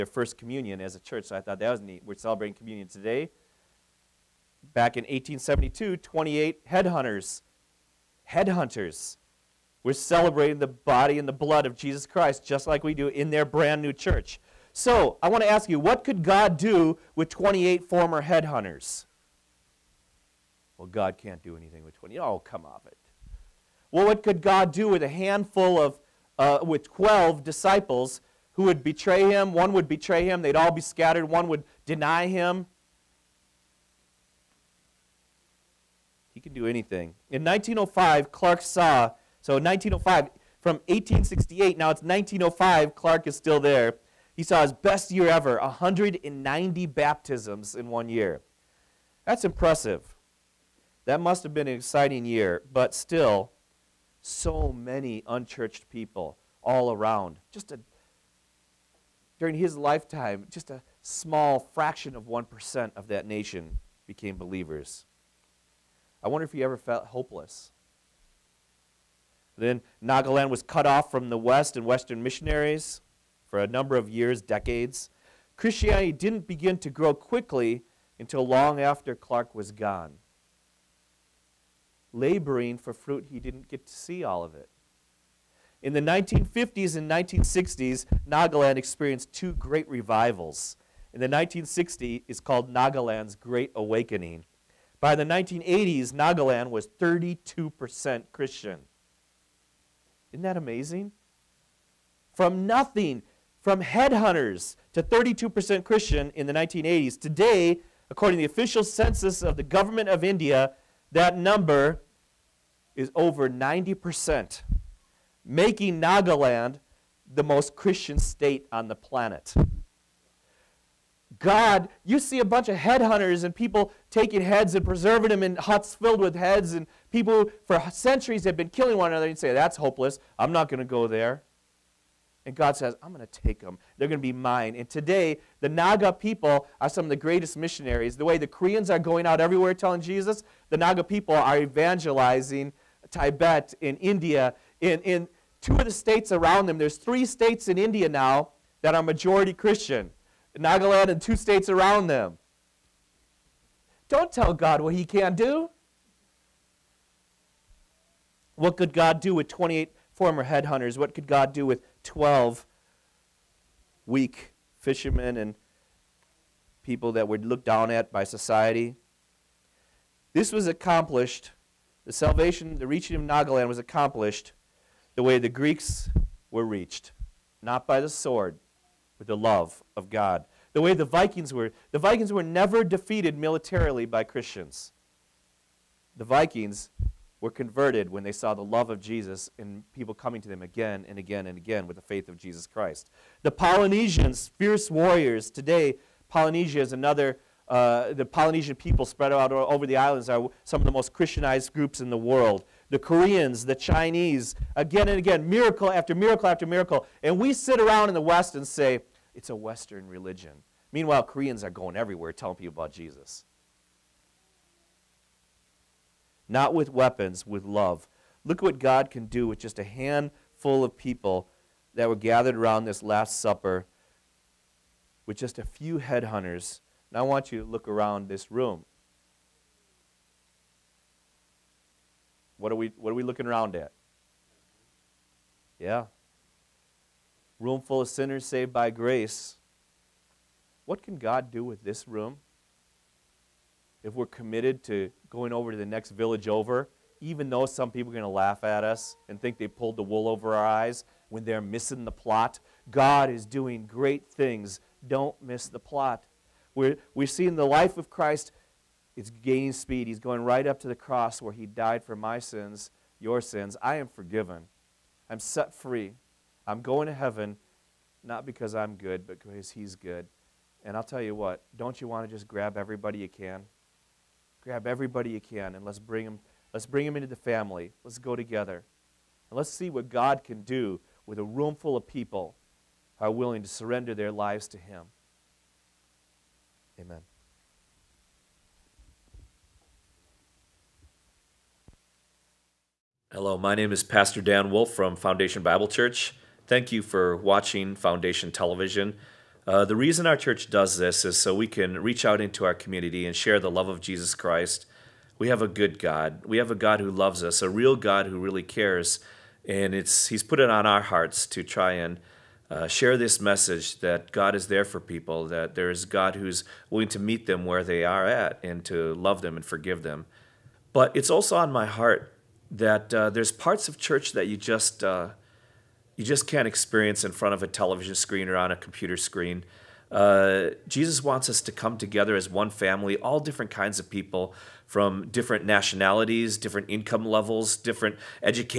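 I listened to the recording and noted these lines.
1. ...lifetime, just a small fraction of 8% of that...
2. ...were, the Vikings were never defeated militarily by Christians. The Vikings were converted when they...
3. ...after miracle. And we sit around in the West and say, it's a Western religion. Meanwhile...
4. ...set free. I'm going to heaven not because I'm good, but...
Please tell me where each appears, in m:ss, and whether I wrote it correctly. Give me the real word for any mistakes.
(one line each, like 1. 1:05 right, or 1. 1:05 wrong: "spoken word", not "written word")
1. 0:59 wrong: "1", not "8"
2. 3:01 right
3. 3:26 right
4. 4:25 right.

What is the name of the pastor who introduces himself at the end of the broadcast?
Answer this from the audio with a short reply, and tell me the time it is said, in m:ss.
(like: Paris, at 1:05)
Dan Wolf, at 4:54.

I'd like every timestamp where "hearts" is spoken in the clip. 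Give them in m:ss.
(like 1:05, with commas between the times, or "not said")
5:11, 5:21.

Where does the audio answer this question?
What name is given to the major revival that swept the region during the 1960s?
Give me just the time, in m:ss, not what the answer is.
1:32.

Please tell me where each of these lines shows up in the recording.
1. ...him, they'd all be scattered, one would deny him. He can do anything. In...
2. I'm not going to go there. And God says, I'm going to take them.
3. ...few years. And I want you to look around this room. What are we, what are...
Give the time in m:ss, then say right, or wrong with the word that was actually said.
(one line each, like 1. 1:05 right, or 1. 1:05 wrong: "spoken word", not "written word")
1. 0:30 right
2. 2:10 right
3. 3:45 wrong: "headhunters", not "years".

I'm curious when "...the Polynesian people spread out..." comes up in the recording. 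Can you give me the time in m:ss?
3:18.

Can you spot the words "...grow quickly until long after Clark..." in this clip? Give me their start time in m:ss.
1:16.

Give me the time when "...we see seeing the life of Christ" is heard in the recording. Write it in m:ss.
4:17.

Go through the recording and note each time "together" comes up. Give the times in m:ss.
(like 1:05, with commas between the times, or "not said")
4:38, 5:31.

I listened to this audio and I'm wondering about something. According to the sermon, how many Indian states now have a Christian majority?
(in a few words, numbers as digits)
3.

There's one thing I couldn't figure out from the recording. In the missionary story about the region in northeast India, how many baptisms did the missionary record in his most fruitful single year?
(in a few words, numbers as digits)
190.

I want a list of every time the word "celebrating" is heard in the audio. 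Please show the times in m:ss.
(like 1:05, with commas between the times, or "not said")
0:02, 0:09.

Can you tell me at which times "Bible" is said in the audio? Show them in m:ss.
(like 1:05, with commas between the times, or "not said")
4:55.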